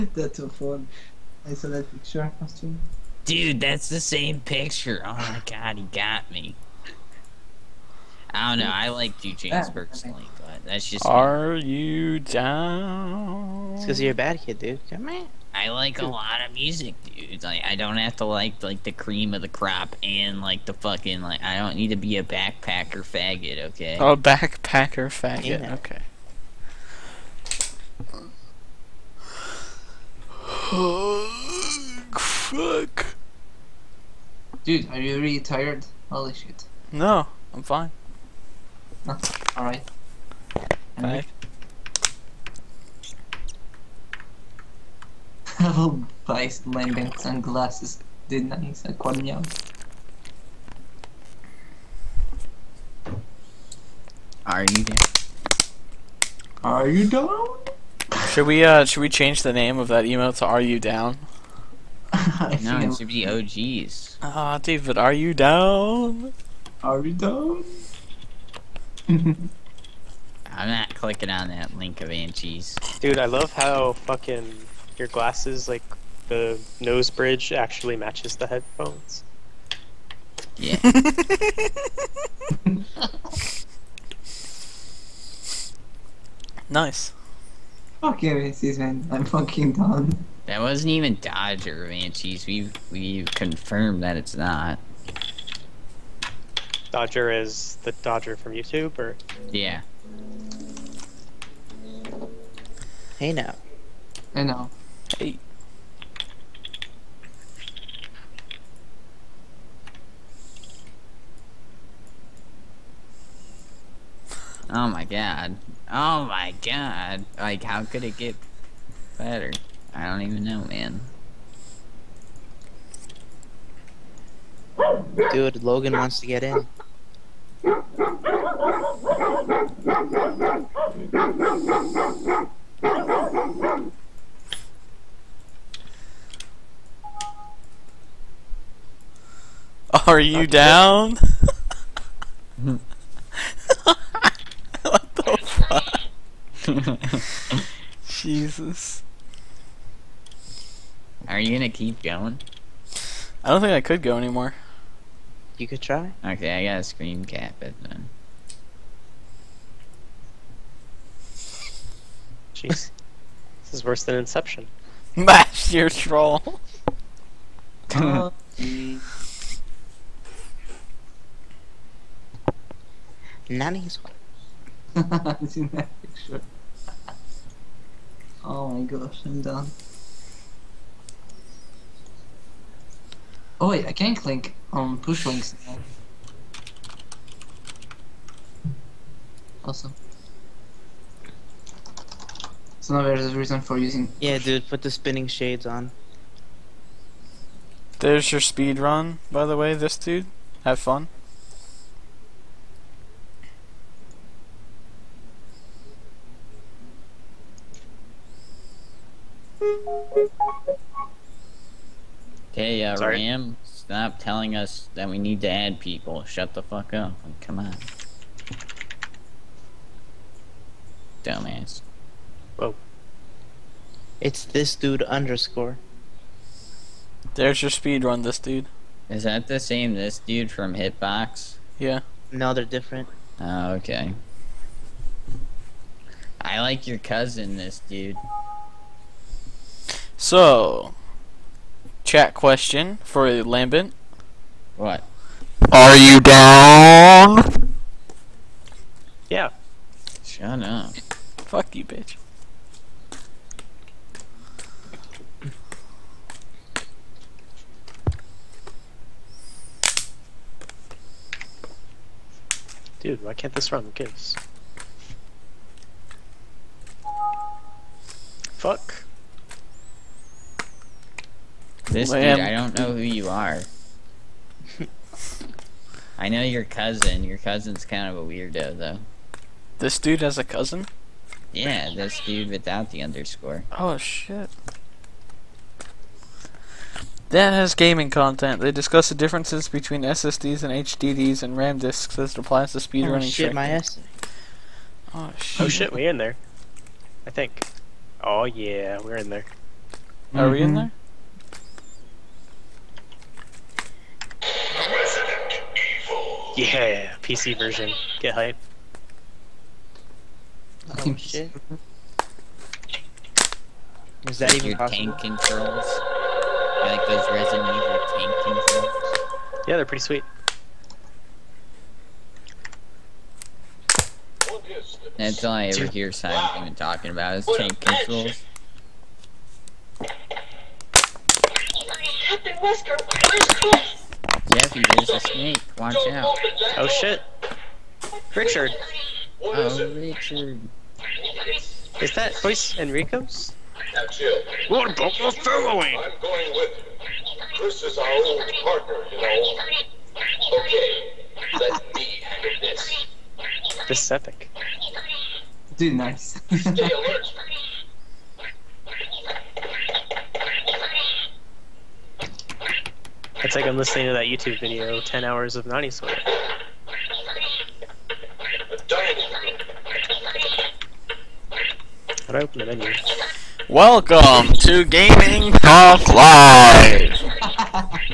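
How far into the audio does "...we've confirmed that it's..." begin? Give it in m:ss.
1:32.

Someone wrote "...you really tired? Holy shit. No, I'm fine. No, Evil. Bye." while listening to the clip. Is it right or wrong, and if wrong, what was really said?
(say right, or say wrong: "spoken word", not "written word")
wrong: "Alright", not "Evil".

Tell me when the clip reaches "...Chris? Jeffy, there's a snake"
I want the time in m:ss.
5:33.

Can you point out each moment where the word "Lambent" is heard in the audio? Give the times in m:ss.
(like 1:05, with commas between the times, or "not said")
0:46, 4:03.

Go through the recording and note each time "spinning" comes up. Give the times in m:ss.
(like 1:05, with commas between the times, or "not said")
3:14.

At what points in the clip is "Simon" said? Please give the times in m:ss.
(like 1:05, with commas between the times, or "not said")
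5:26.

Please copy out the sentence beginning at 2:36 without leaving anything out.
Okay, I got a screen cap it then.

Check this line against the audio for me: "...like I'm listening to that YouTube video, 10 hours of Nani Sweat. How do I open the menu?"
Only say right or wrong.
right.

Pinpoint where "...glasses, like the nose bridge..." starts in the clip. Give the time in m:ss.
1:15.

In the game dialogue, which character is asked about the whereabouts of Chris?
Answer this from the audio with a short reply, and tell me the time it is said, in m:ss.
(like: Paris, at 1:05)
Captain Wesker, at 5:30.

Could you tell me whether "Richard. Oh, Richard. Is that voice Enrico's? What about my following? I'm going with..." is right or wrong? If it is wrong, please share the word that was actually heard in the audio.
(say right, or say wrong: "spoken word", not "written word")
right.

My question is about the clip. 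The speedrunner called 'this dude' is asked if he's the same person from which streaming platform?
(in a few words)
Hitbox.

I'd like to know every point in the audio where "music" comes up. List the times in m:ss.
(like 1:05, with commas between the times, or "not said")
0:16.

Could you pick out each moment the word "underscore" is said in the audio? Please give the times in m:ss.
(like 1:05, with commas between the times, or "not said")
3:45, 4:43.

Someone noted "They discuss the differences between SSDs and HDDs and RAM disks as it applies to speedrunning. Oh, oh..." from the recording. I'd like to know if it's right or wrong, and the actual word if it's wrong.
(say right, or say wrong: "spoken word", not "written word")
right.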